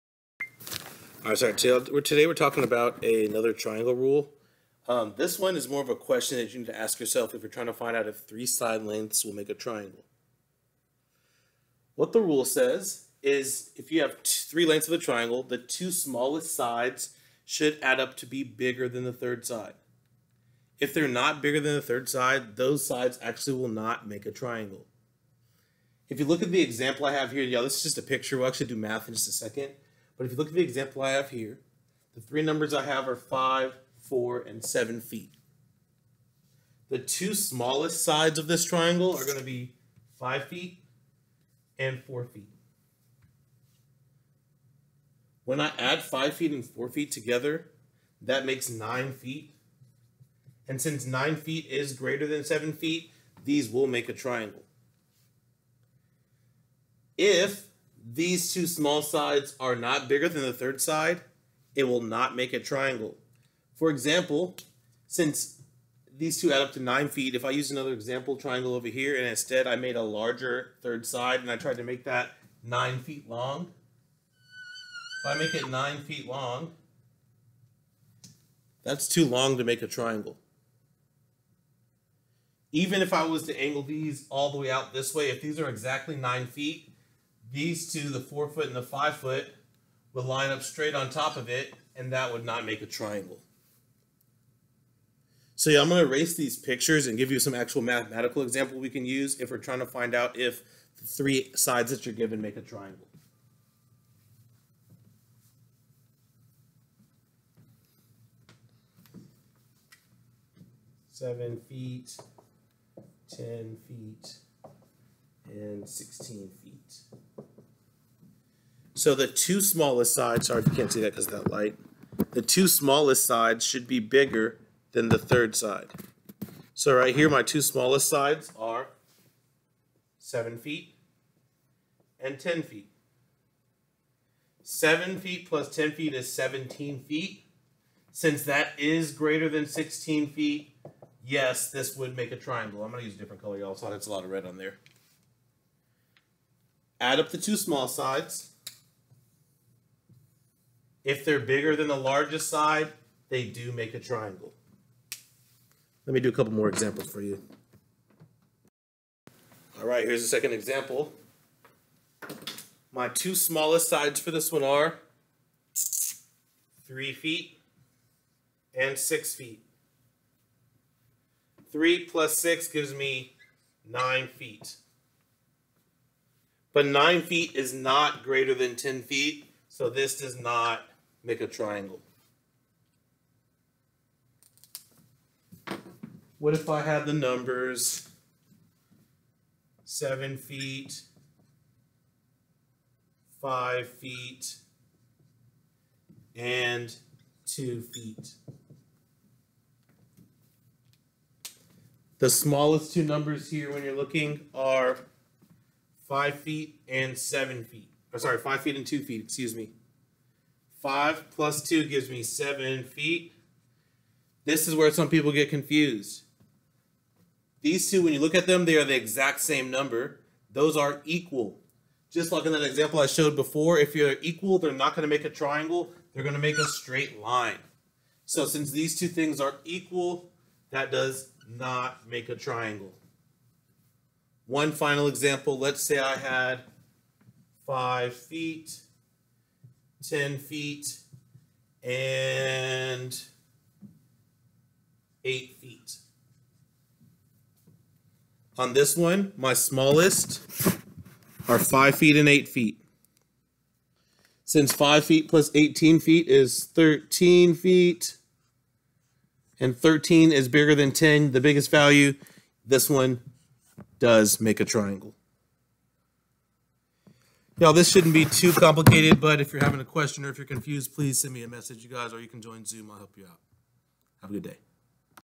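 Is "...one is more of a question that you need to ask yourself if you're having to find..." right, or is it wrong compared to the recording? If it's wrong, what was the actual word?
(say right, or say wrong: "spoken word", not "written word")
wrong: "trying", not "having".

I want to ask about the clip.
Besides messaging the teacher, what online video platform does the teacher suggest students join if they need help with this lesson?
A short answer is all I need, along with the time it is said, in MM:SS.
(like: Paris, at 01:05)
Zoom, at 04:32.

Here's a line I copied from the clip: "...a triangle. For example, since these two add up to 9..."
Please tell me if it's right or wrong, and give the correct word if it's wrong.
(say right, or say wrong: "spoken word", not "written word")
right.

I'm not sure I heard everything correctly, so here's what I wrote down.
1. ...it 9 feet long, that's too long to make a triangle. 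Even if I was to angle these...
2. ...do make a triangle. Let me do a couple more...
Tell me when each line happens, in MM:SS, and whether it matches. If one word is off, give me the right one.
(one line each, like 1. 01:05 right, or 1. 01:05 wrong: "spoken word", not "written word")
1. 01:15 right
2. 02:33 right.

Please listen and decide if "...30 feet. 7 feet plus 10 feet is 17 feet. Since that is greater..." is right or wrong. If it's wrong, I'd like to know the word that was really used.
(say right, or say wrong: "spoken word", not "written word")
wrong: "10", not "30".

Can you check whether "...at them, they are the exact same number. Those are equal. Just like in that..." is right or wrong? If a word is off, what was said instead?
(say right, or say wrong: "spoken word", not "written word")
right.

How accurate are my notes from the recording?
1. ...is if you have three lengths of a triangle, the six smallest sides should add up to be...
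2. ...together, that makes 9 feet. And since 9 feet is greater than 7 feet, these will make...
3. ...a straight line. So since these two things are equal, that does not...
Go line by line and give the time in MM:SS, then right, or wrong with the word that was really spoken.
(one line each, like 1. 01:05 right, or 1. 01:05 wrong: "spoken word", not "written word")
1. 00:13 wrong: "two", not "six"
2. 00:47 right
3. 03:46 right.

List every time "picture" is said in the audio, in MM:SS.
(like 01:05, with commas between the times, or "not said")
00:28, 01:36.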